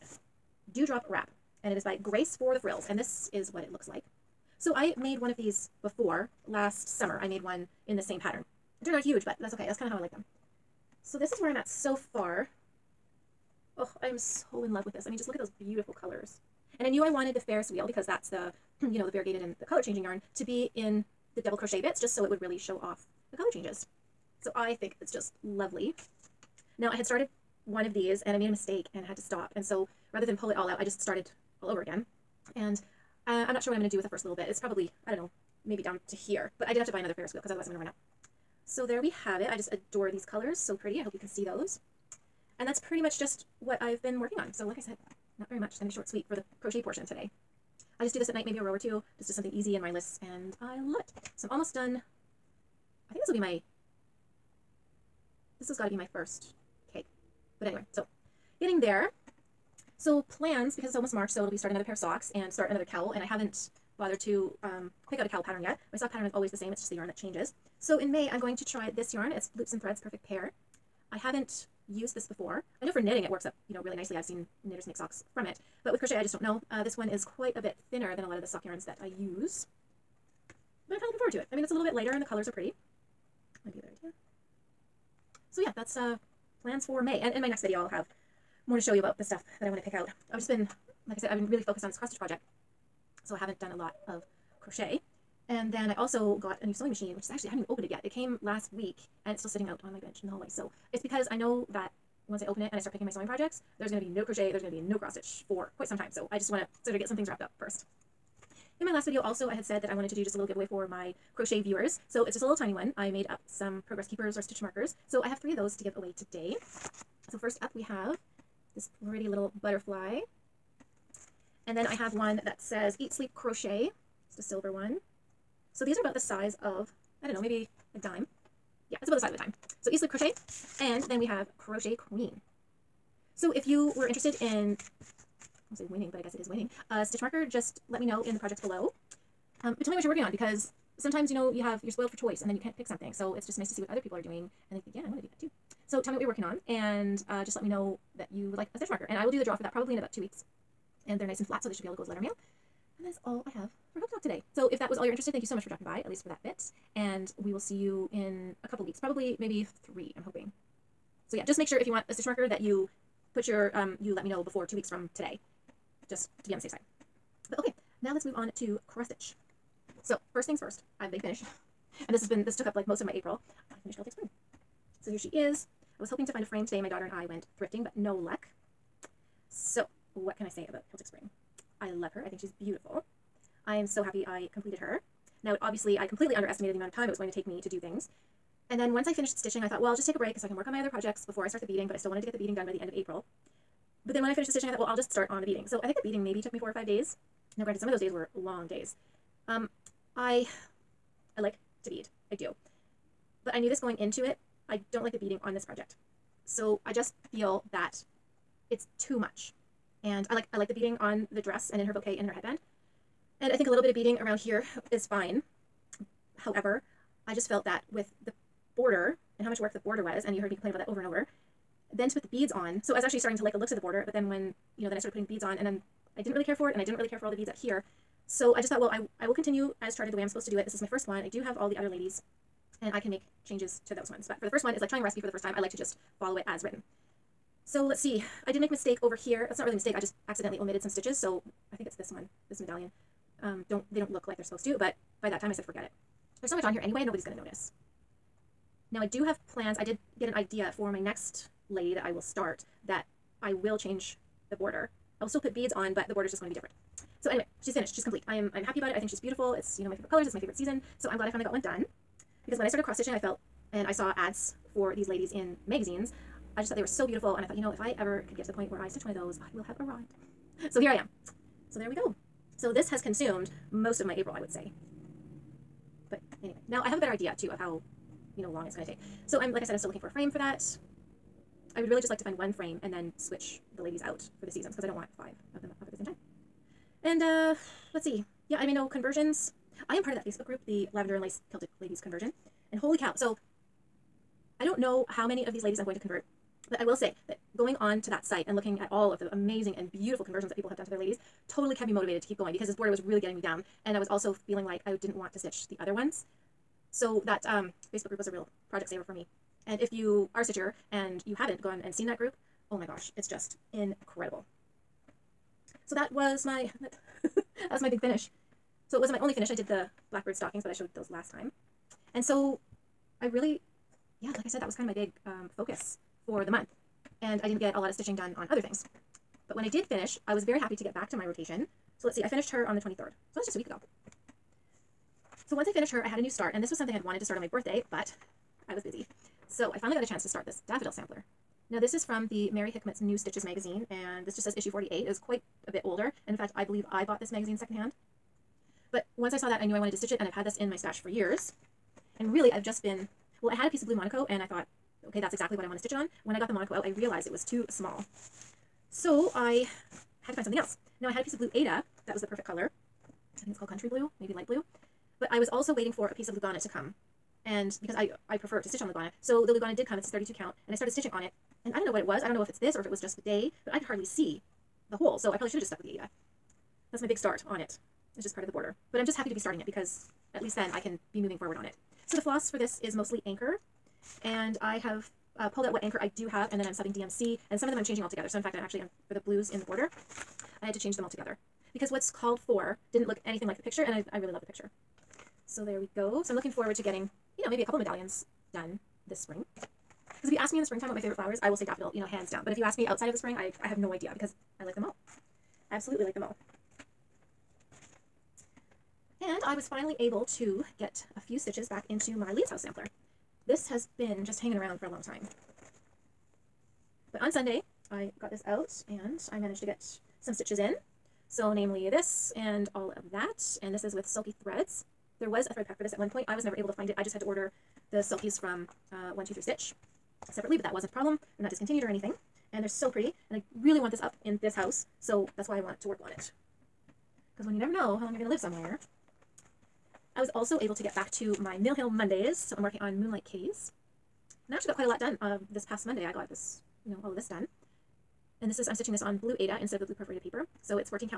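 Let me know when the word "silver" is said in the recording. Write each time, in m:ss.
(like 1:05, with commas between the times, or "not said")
2:04.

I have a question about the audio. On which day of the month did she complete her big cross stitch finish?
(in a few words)
23rd.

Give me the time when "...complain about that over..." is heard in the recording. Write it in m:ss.
3:40.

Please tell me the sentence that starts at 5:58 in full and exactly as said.
So I had to find something else.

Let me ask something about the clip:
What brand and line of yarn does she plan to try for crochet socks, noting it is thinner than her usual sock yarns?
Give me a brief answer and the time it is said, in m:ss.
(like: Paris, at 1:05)
Loops and Threads Perfect Pair, at 1:09.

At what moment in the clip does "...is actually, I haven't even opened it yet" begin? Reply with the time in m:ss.
1:37.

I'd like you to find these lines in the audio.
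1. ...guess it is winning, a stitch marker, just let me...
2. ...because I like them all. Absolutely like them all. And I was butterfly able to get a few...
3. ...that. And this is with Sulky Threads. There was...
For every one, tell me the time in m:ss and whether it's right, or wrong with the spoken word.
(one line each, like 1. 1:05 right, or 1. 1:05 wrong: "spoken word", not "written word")
1. 2:16 right
2. 6:44 wrong: "finally", not "butterfly"
3. 7:03 right.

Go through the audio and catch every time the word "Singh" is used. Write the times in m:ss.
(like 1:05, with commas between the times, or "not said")
not said.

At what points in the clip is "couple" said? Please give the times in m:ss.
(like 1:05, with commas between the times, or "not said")
2:38, 6:37.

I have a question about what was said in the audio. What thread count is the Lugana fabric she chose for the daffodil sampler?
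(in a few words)
32.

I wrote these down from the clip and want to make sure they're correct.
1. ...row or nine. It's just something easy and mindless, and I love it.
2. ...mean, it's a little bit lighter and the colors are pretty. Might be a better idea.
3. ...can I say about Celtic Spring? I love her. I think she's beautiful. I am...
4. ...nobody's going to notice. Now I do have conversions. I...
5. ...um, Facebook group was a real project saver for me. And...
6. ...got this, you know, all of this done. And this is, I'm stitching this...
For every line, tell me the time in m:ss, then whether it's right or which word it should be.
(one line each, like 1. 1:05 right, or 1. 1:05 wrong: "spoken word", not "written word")
1. 0:48 wrong: "two", not "nine"
2. 1:21 right
3. 3:00 right
4. 4:07 wrong: "plans", not "conversions"
5. 5:07 right
6. 7:26 right.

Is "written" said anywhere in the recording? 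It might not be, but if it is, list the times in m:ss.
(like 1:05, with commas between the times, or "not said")
3:56.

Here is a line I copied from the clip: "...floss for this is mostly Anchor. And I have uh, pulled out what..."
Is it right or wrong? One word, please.
right.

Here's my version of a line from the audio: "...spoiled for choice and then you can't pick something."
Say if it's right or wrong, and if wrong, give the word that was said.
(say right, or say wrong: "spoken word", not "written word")
right.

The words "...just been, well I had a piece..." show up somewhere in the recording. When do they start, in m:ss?
5:52.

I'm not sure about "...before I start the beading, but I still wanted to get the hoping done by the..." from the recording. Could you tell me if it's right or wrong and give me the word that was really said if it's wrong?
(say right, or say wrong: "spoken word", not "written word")
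wrong: "beading", not "hoping".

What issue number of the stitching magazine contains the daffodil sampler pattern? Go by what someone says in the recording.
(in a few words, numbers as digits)
48.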